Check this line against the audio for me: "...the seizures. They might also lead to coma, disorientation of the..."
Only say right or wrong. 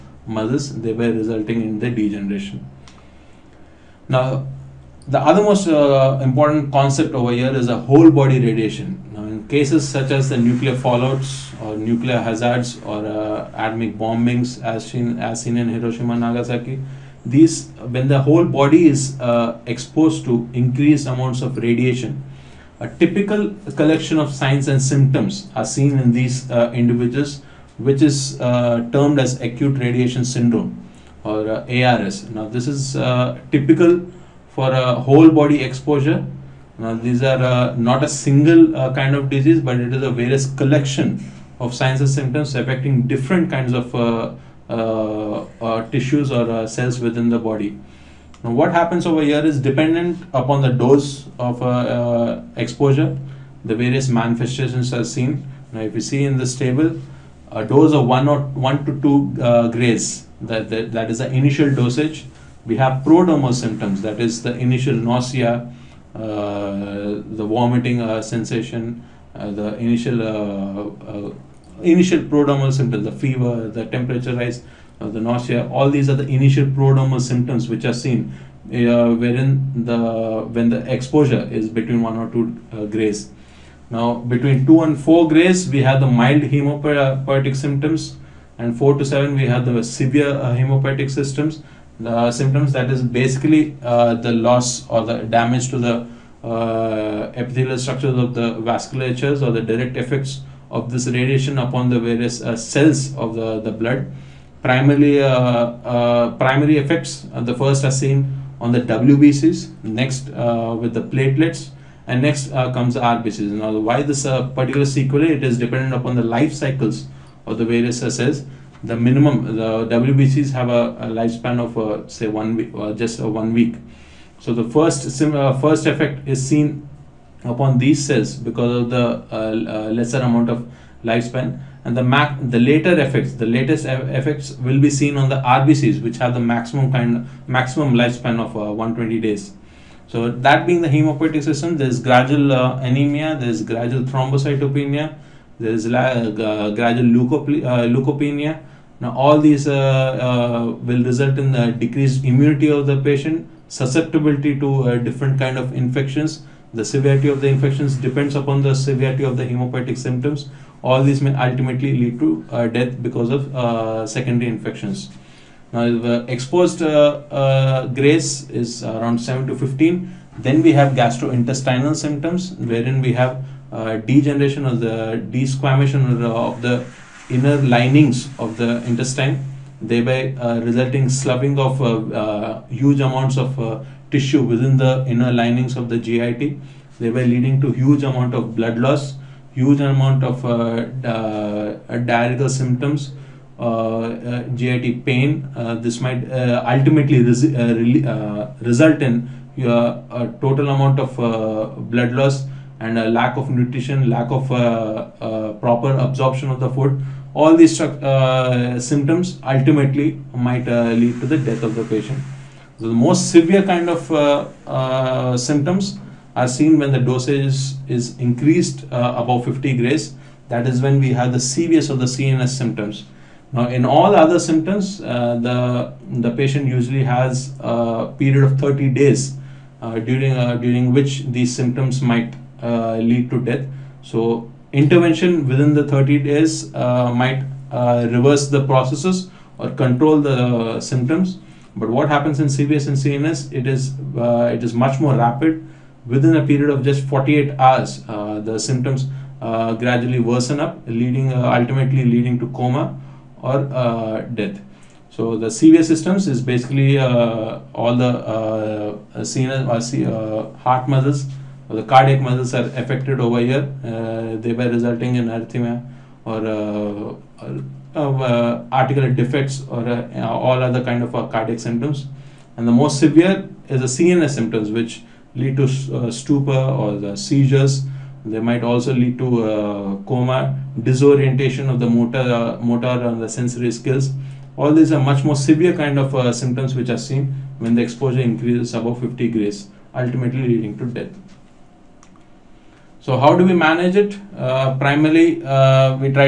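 right.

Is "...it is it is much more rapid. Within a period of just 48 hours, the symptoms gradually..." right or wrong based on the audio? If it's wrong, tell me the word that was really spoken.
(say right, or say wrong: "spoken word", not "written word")
right.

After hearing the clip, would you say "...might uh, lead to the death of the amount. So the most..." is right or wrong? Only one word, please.
wrong.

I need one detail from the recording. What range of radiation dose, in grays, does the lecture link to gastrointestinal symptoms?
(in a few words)
7 to 15.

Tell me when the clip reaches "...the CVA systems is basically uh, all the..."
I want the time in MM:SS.
04:15.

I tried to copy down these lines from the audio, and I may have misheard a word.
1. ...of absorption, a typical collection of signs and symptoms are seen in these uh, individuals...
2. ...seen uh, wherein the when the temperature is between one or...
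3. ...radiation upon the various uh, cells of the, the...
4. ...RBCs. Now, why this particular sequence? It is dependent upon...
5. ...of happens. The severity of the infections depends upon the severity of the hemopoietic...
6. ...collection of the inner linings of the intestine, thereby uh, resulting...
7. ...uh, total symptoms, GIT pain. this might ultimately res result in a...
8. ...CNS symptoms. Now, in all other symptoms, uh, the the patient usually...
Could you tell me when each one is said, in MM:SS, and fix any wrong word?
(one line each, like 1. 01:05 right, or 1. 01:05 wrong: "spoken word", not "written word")
1. 00:21 wrong: "radiation", not "absorption"
2. 01:17 wrong: "exposure", not "temperature"
3. 01:41 right
4. 01:53 right
5. 02:35 wrong: "infections", not "happens"
6. 02:55 wrong: "desquamation", not "collection"
7. 03:10 wrong: "diarrheal", not "total"
8. 03:42 right.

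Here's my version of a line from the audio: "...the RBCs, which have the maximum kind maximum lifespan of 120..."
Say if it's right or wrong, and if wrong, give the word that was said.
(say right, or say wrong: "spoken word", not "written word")
right.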